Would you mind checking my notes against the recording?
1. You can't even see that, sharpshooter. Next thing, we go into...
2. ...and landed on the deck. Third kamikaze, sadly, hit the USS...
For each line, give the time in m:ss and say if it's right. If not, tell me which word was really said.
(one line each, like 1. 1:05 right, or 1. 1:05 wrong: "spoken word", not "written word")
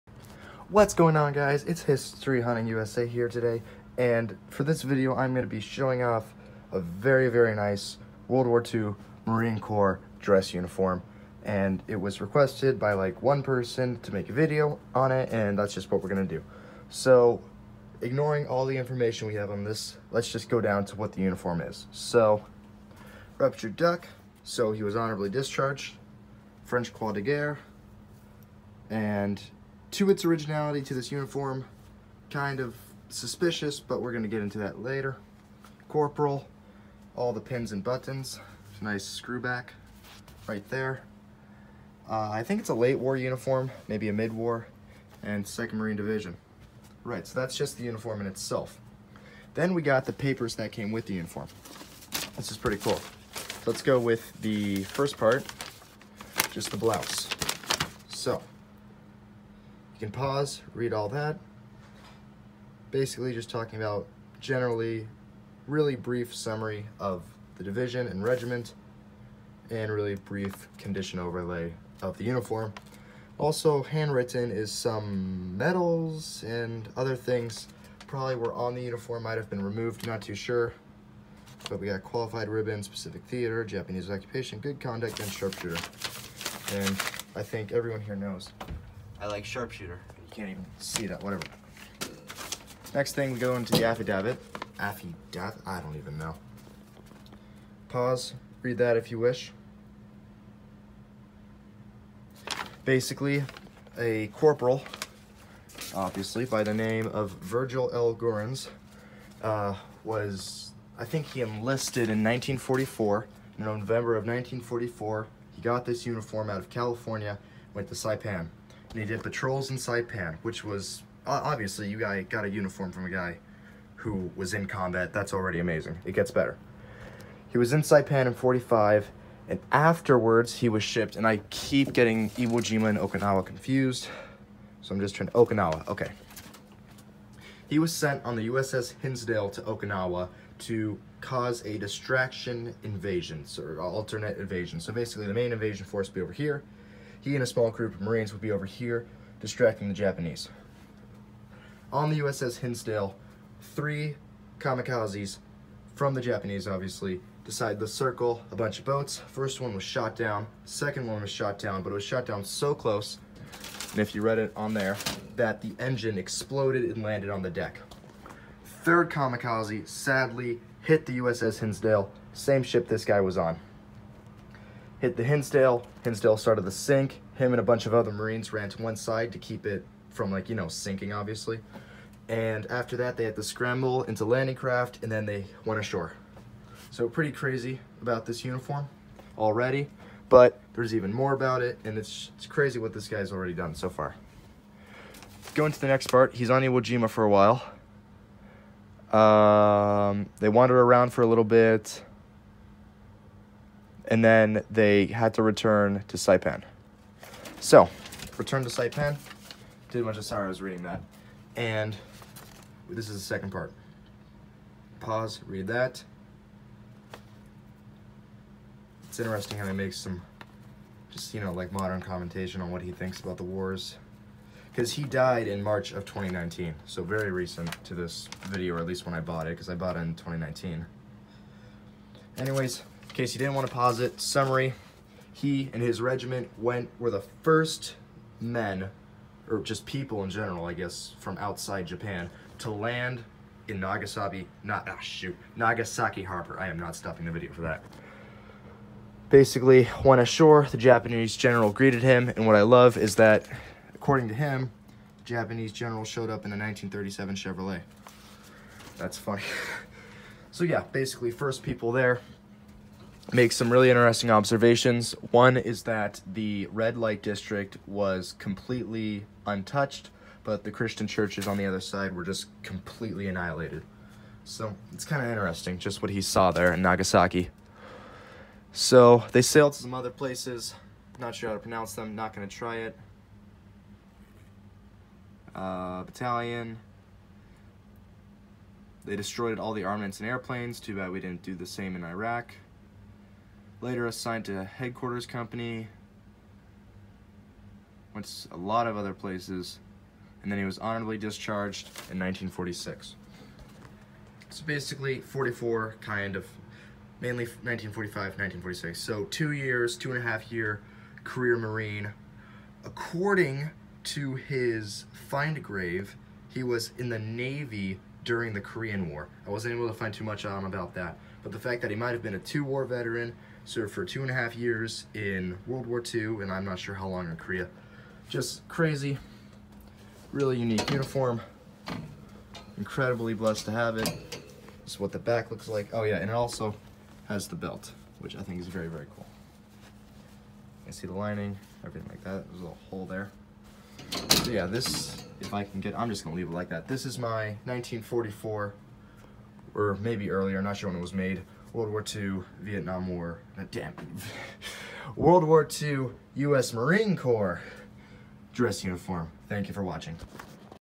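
1. 1:30 wrong: "whatever", not "sharpshooter"
2. 2:46 right.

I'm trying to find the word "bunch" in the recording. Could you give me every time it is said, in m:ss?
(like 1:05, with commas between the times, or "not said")
2:38, 2:57.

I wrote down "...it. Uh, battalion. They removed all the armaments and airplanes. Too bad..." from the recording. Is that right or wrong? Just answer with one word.
wrong.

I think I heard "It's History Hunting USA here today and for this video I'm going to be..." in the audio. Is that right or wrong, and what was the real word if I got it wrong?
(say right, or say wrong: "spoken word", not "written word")
right.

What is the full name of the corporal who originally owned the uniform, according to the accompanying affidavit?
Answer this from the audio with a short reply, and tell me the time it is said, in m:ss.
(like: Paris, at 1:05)
Virgil L. Gorans, at 1:47.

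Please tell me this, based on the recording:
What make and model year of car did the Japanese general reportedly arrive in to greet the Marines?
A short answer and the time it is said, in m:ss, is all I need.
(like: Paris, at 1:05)
1937 Chevrolet, at 4:16.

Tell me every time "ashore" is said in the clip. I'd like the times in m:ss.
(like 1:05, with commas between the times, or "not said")
3:05, 4:10.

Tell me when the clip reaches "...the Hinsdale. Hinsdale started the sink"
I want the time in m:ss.
2:55.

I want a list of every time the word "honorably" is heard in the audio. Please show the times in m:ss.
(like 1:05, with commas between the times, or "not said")
0:24, 5:00.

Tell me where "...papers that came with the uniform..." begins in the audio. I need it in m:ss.
0:50.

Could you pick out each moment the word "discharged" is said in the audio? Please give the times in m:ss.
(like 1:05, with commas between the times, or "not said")
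0:25, 5:01.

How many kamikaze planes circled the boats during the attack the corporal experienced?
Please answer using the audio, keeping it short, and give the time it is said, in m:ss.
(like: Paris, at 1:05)
3, at 2:33.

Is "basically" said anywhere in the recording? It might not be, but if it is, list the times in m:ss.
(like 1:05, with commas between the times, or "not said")
1:02, 1:42, 2:24, 4:09, 4:20, 5:04.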